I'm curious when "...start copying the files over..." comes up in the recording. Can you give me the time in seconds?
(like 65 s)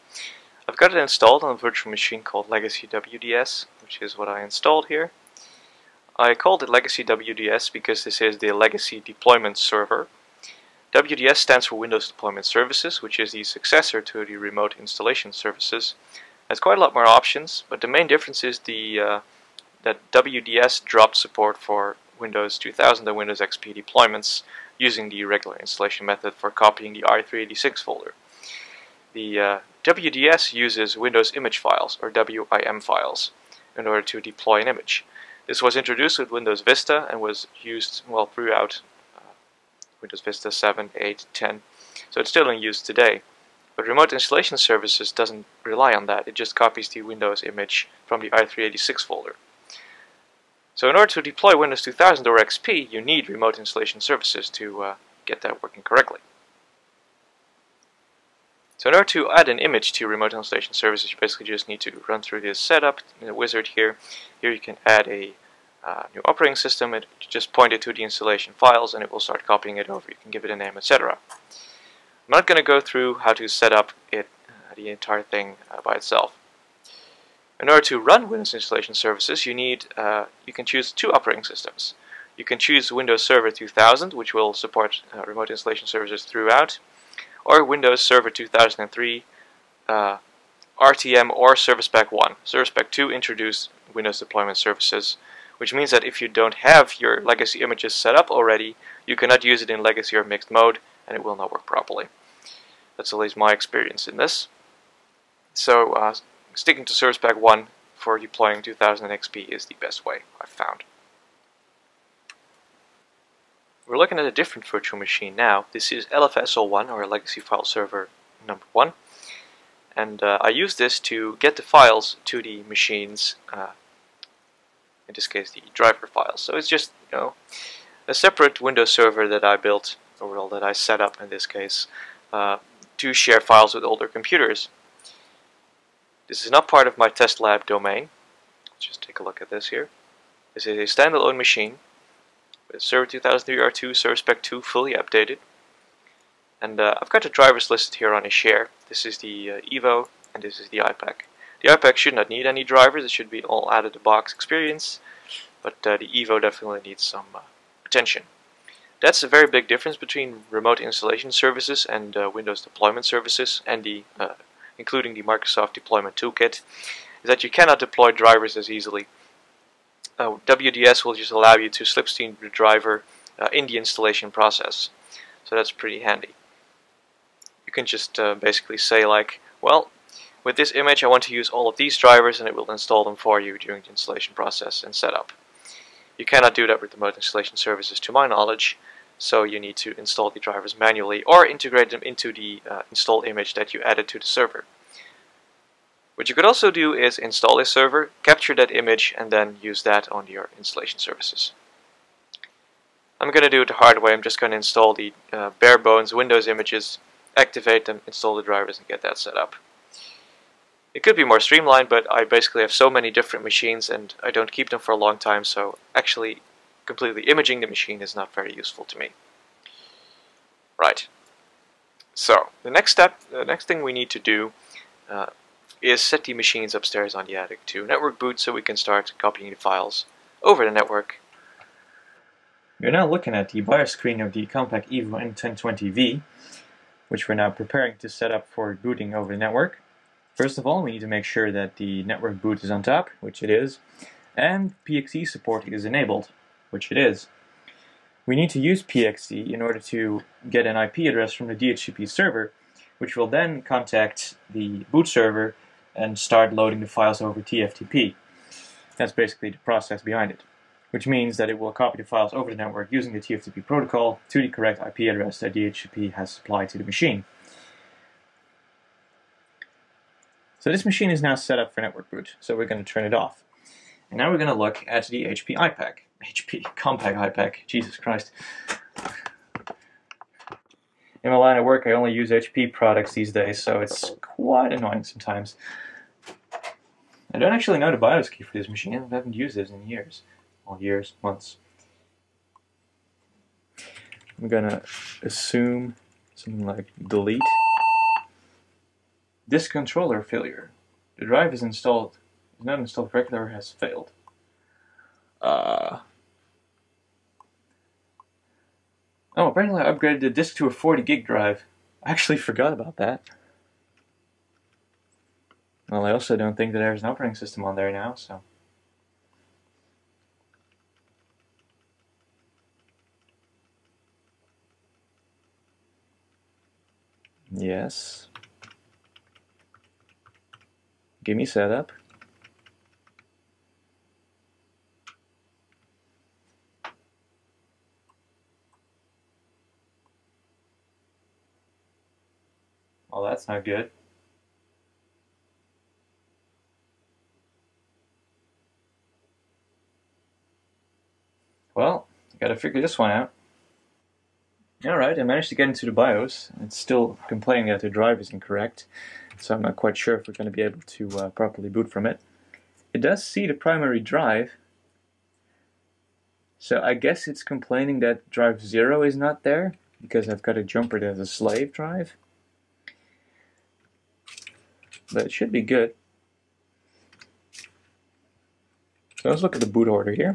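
228 s.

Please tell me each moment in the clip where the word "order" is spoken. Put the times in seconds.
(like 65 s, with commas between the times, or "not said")
33 s, 50 s, 58 s, 77 s, 249 s.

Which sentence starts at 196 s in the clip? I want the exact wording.
What you could also do is install a server, capture that image, and then use that on your installation services.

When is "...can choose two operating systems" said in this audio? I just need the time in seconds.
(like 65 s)
80 s.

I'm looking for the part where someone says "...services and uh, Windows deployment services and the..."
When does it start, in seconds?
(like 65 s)
161 s.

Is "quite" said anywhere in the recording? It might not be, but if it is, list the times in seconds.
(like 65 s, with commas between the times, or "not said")
16 s, 284 s, 359 s.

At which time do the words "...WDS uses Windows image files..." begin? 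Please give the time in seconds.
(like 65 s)
29 s.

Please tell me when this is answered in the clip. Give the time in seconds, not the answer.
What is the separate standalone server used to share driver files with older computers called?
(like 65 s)
116 s.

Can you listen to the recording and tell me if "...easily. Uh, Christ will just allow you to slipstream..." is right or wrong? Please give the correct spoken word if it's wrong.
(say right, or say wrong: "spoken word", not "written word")
wrong: "WDS", not "Christ".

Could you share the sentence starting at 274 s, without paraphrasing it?
And now we're going to look at the HP iPAQ.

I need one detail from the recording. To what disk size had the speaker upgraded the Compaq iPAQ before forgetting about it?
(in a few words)
40 gig.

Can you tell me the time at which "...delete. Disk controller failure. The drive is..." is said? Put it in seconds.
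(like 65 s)
297 s.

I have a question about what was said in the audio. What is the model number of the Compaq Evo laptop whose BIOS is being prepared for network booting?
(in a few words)
N1020V.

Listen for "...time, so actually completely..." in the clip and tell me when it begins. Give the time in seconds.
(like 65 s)
215 s.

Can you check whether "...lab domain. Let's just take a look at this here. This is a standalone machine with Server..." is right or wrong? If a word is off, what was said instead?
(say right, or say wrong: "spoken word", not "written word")
right.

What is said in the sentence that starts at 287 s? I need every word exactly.
I don't actually know the BIOS key for this machine.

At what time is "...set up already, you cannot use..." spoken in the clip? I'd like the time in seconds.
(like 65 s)
97 s.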